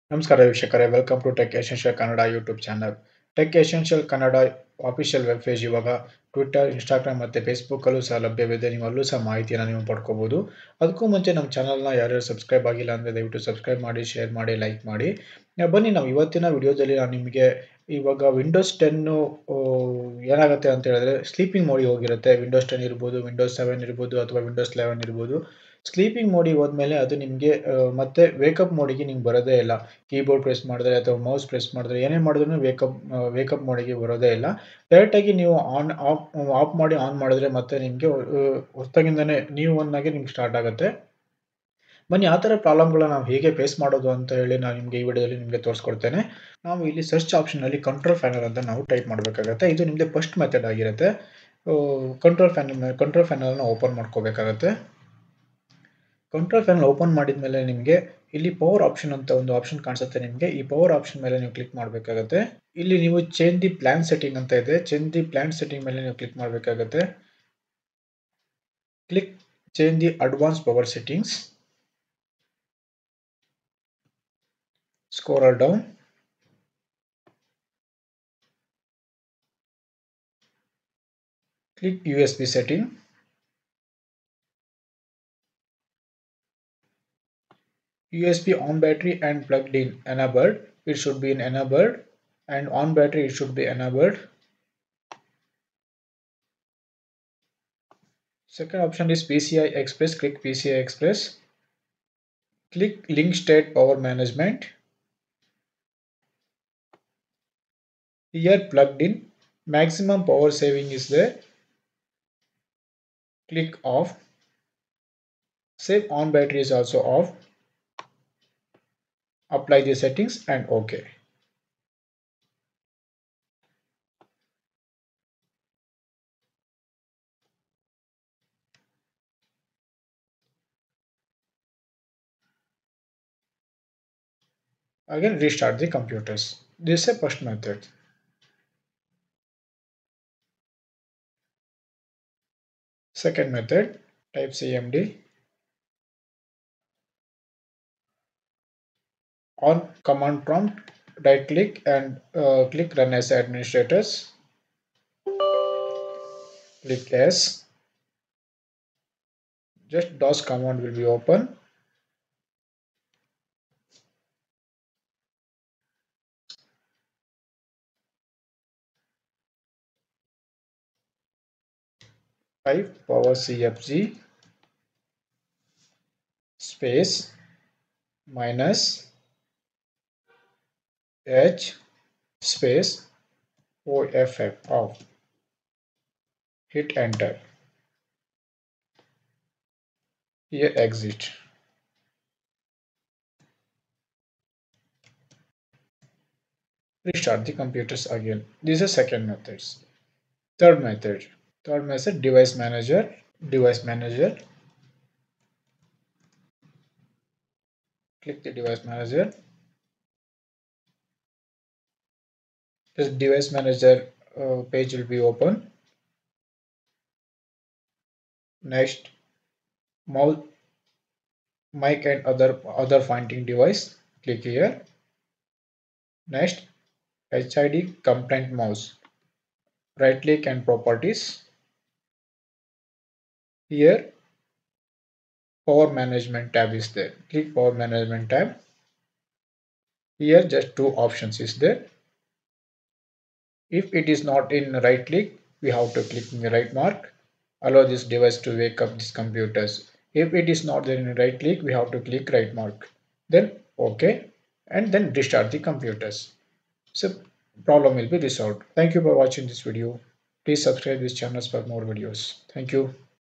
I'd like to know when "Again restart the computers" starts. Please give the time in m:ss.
2:15.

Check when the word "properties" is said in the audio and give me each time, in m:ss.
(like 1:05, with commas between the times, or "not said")
3:50.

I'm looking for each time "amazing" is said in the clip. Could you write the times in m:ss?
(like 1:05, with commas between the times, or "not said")
not said.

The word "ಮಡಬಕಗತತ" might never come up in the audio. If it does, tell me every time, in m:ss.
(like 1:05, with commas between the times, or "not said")
0:49, 1:01, 1:06.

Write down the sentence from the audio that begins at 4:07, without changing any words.
Allow this device to wake up these computers.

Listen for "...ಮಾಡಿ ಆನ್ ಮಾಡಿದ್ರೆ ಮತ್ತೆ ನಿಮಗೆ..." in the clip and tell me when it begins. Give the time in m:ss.
0:36.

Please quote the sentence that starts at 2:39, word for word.
Just DOS command will be open.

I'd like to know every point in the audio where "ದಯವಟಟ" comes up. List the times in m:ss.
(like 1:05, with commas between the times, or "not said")
0:13.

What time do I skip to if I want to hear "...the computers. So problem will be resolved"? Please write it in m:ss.
4:15.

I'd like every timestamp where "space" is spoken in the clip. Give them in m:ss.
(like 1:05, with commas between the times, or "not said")
2:56, 3:02.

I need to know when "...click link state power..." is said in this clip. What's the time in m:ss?
1:42.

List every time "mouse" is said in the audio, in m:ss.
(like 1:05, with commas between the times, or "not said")
3:40, 3:48.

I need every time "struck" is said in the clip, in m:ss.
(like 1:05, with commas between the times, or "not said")
not said.